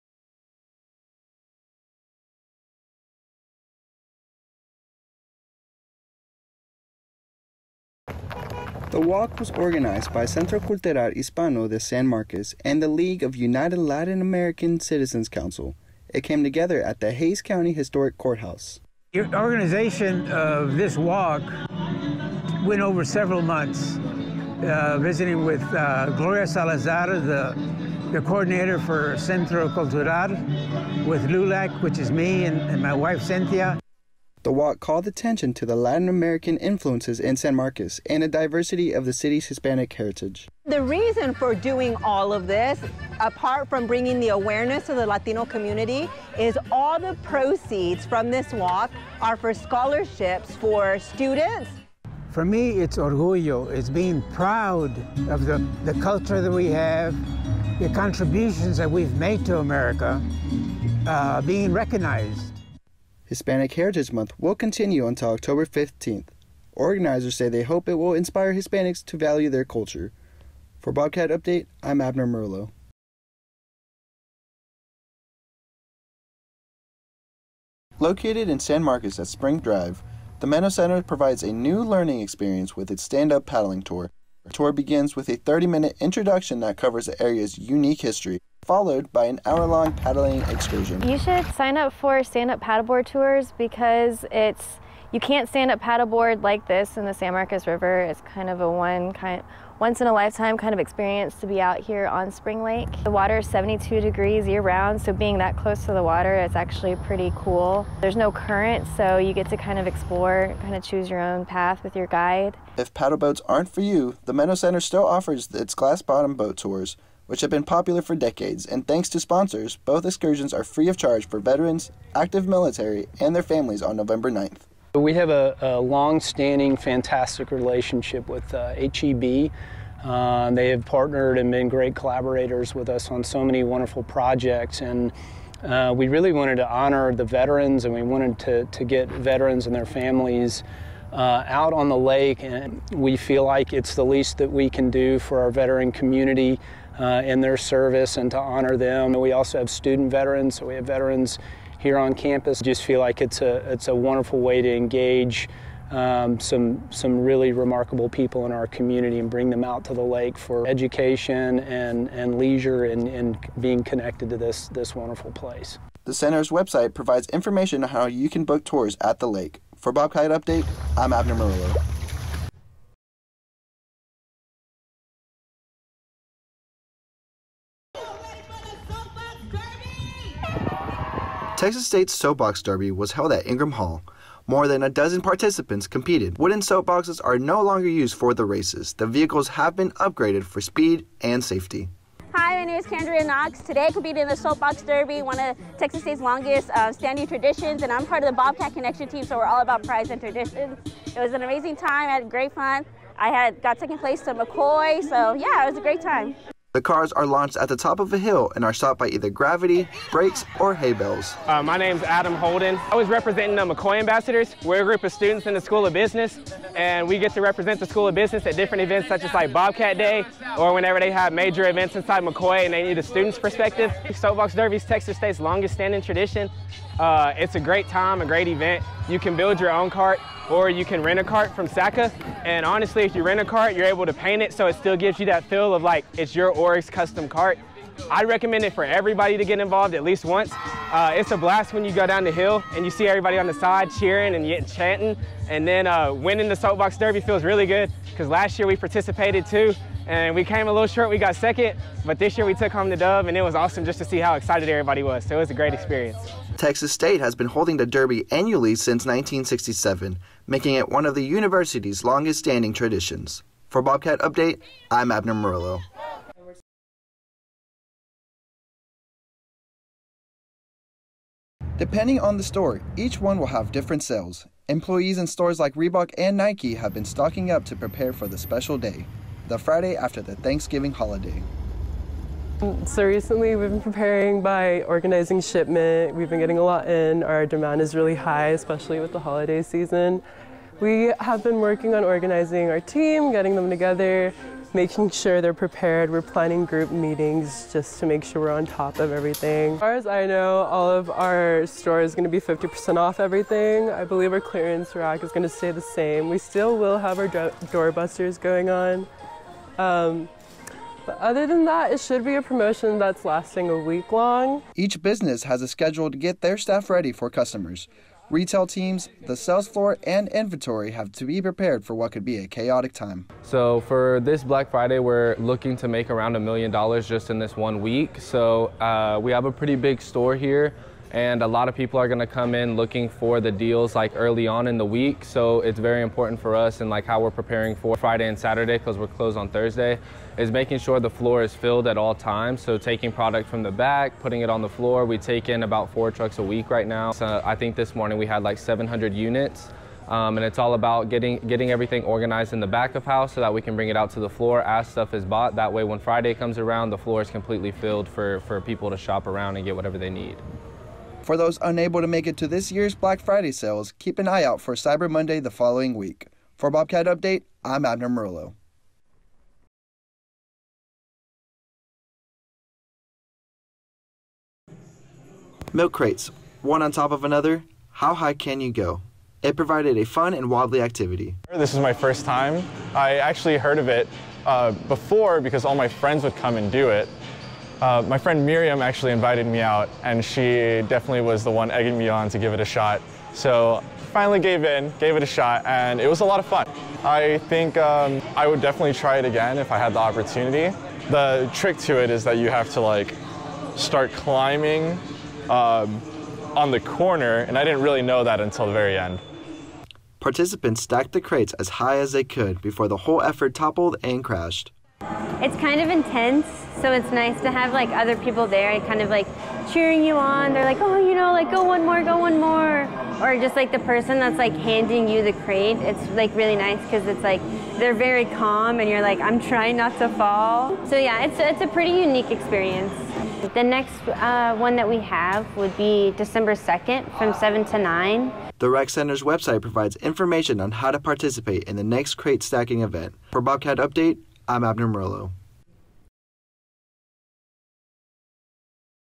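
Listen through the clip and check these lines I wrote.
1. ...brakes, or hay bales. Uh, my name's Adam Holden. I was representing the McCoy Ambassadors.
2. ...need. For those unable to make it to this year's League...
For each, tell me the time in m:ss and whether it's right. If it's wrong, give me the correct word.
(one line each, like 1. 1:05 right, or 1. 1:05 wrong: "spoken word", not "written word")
1. 3:30 right
2. 6:00 wrong: "Black", not "League".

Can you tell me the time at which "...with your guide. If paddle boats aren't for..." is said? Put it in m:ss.
1:51.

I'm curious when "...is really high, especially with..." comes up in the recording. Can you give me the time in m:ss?
4:47.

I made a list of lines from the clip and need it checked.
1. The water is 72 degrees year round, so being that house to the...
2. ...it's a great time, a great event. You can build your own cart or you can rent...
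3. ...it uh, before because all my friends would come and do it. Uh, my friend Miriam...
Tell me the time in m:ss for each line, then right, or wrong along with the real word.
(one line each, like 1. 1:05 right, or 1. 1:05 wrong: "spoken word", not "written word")
1. 1:43 wrong: "close", not "house"
2. 3:47 right
3. 6:23 right.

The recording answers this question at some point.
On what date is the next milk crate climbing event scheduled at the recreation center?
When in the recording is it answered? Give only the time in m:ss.
7:16.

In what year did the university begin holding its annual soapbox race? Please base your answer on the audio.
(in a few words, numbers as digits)
1967.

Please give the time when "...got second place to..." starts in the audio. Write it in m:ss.
3:23.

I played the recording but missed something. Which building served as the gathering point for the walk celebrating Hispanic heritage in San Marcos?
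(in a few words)
Hays County Historic Courthouse.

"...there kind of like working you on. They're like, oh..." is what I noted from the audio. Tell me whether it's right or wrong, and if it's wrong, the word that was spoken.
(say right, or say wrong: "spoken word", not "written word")
wrong: "cheering", not "working".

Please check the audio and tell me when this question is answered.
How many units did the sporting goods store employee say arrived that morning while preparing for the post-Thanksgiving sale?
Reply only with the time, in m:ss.
5:48.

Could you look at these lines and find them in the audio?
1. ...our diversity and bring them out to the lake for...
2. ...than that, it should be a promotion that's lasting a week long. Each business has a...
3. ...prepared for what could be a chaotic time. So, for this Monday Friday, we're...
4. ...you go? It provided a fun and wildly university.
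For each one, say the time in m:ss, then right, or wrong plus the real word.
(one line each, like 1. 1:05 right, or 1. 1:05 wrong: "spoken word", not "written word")
1. 2:38 wrong: "community", not "diversity"
2. 5:11 right
3. 5:21 wrong: "Black", not "Monday"
4. 6:18 wrong: "activity", not "university".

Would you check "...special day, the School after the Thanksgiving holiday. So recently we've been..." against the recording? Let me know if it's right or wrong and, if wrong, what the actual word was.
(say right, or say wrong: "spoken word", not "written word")
wrong: "Friday", not "School".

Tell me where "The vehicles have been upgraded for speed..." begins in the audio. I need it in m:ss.
3:08.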